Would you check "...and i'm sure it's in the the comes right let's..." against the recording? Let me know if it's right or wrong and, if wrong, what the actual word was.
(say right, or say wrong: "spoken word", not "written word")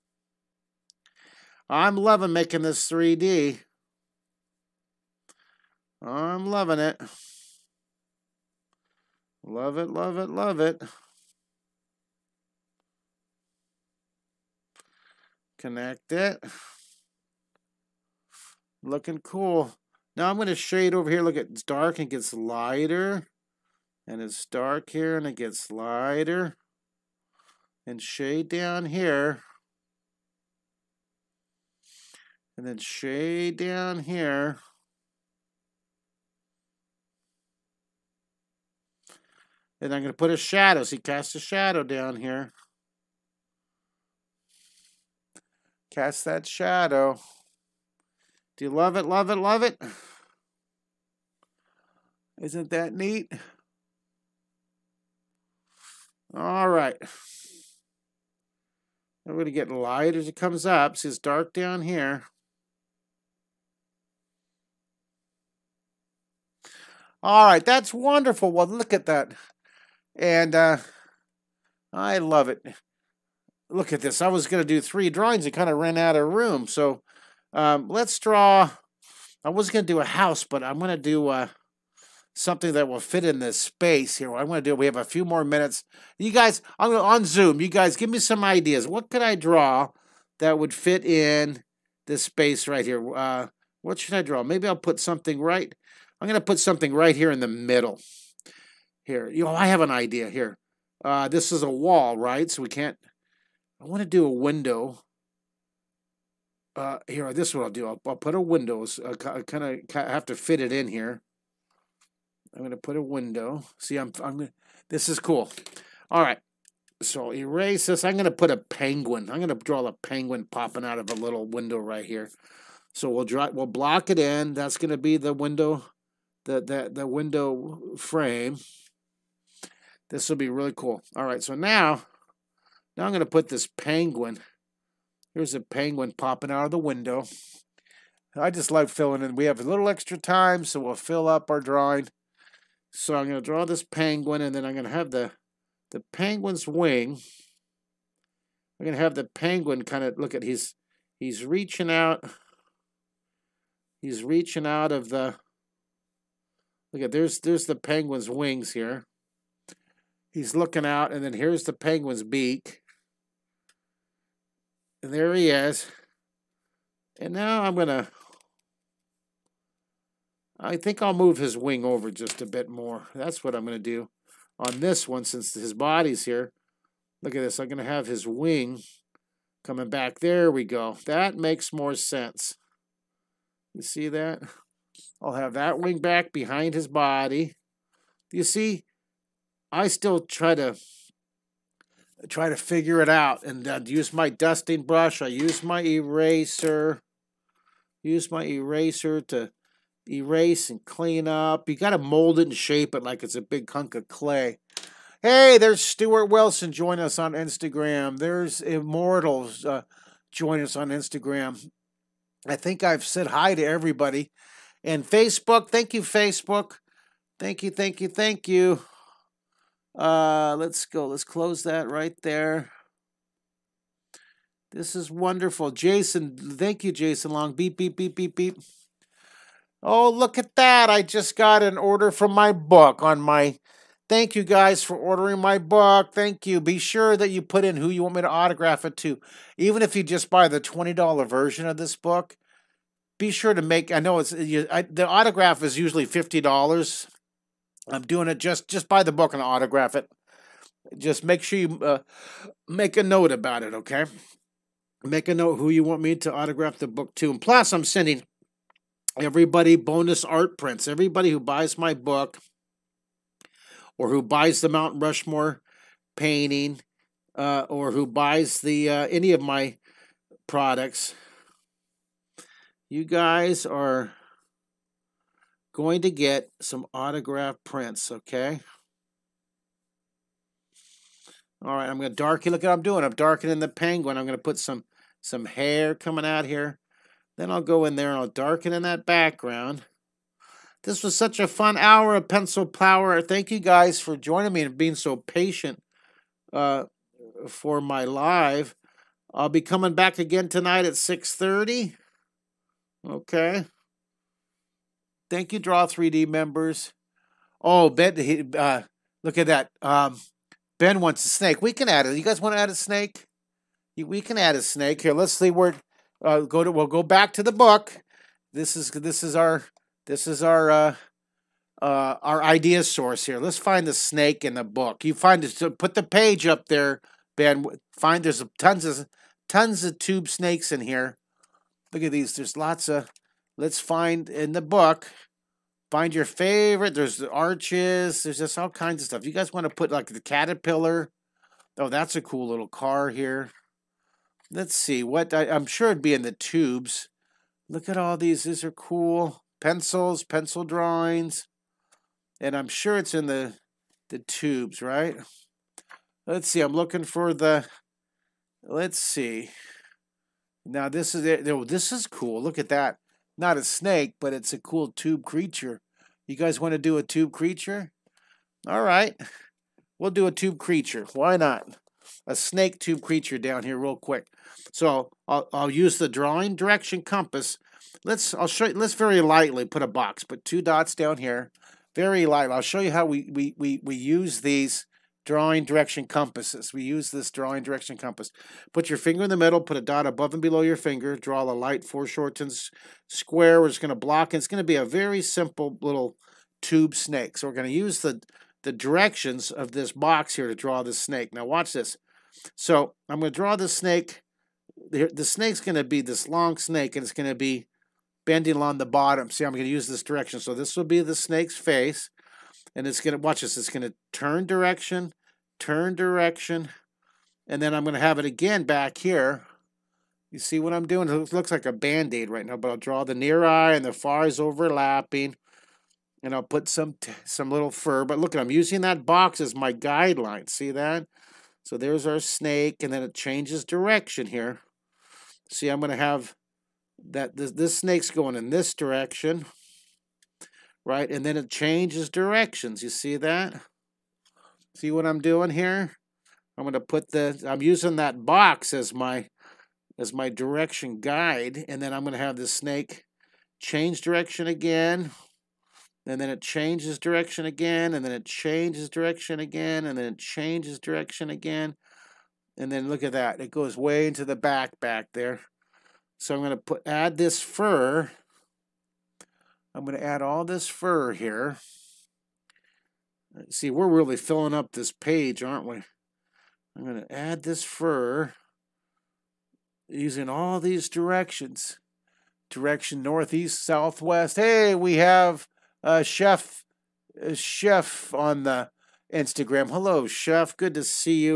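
wrong: "tubes", not "comes".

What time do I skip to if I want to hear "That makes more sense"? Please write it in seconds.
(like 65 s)
181 s.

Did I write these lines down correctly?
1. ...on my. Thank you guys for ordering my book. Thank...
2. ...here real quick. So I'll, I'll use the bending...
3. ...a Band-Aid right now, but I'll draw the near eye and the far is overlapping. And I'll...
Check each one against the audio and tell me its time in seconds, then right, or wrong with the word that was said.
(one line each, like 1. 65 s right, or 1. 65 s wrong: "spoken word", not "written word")
1. 233 s right
2. 373 s wrong: "drawing", not "bending"
3. 421 s right.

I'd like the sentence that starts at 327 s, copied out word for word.
Find there's tons of tons of tube snakes in here.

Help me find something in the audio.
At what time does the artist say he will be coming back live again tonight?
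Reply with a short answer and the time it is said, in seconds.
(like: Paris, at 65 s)
6:30, at 300 s.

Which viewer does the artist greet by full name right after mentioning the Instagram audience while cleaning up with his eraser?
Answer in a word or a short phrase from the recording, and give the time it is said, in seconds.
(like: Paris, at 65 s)
Stuart Wilson, at 205 s.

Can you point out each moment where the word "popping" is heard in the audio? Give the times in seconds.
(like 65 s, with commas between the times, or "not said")
120 s, 136 s.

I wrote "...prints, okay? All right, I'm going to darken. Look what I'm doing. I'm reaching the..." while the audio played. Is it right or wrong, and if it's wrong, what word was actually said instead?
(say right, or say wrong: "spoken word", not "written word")
wrong: "darkening", not "reaching".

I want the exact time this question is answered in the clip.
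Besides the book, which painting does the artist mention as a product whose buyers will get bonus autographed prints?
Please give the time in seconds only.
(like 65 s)
264 s.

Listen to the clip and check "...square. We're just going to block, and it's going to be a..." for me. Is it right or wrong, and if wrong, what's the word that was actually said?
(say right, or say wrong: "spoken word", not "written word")
right.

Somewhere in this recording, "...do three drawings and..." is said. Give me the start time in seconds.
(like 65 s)
74 s.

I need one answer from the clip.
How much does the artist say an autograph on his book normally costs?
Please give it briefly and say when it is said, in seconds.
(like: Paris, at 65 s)
$50, at 246 s.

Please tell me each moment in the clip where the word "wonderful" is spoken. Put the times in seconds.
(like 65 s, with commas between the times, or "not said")
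67 s, 225 s.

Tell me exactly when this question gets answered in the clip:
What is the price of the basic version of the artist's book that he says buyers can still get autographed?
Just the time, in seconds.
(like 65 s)
240 s.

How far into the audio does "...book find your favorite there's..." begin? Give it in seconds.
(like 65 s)
334 s.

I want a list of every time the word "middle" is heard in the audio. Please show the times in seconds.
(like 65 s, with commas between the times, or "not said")
97 s, 389 s.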